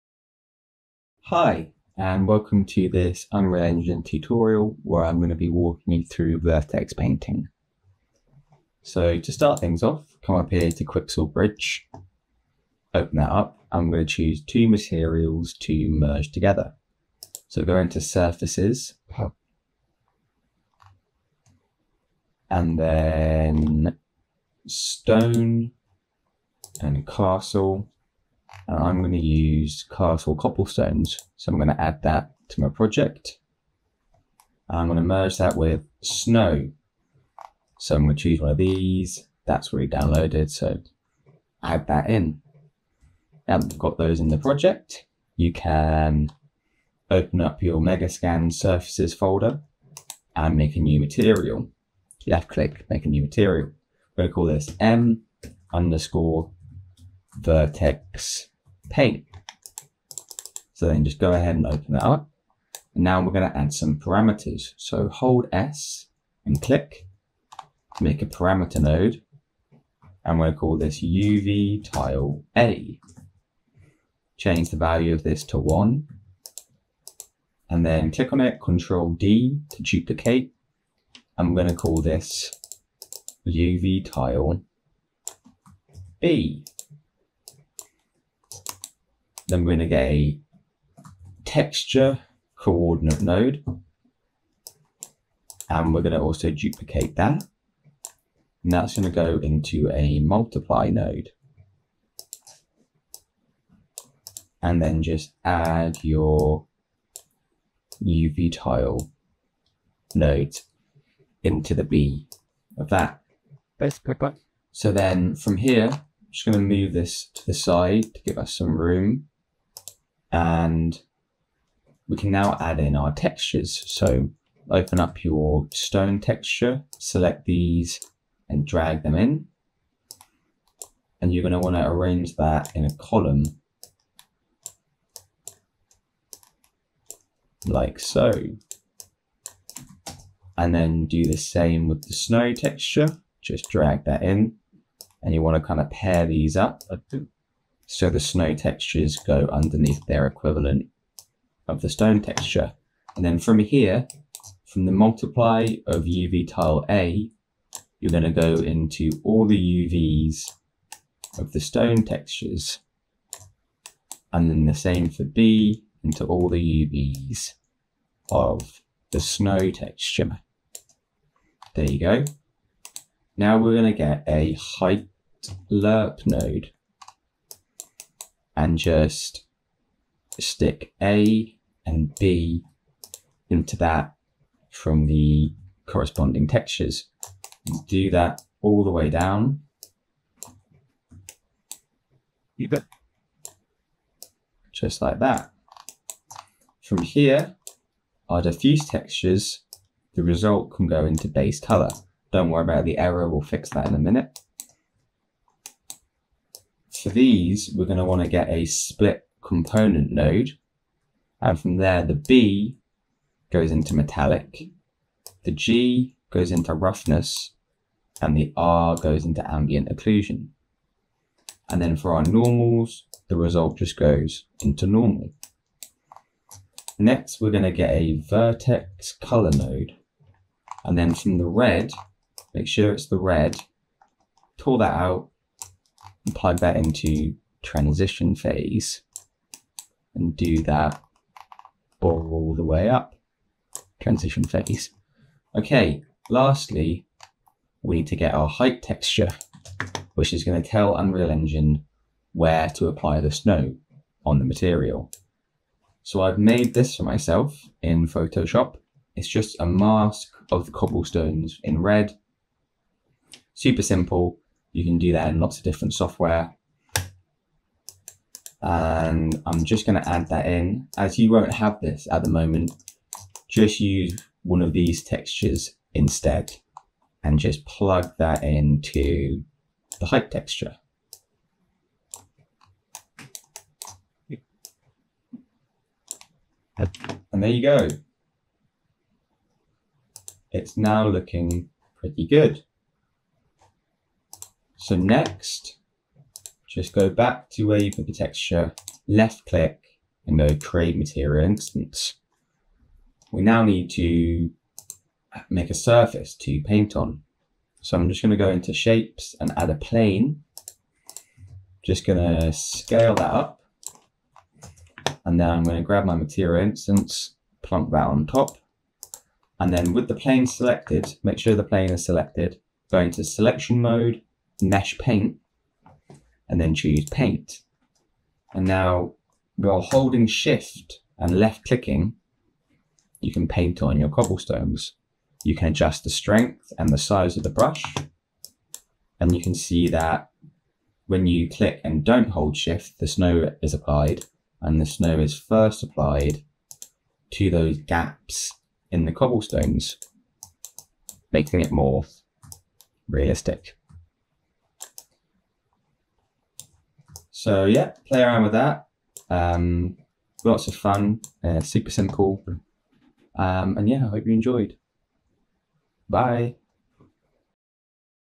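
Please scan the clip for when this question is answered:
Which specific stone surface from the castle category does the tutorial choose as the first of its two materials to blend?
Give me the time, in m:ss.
0:29.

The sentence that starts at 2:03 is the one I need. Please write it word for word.
So open up your stone texture, select these and drag them in.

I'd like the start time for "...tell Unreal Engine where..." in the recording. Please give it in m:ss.
4:10.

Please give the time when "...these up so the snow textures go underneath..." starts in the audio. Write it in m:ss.
2:26.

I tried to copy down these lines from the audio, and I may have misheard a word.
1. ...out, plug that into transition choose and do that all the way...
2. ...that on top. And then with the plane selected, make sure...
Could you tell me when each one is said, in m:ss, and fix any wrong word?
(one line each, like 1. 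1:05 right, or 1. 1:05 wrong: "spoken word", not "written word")
1. 3:54 wrong: "phase", not "choose"
2. 5:17 right.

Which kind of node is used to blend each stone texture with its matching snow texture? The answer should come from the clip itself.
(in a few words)
height lerp.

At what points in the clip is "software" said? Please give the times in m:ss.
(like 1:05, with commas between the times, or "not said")
4:25.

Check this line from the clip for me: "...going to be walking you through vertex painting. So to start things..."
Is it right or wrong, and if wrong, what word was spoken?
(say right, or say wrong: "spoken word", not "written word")
right.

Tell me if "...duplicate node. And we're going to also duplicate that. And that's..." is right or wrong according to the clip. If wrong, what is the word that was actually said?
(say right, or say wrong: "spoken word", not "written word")
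wrong: "coordinate", not "duplicate".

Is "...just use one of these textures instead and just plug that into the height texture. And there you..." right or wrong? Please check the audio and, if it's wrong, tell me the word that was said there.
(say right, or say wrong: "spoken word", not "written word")
right.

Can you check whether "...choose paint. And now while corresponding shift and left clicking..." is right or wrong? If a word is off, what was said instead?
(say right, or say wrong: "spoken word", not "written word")
wrong: "holding", not "corresponding".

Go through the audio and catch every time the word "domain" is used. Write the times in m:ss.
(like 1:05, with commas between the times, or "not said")
not said.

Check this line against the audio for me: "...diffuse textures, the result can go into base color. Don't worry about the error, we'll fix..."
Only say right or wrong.
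right.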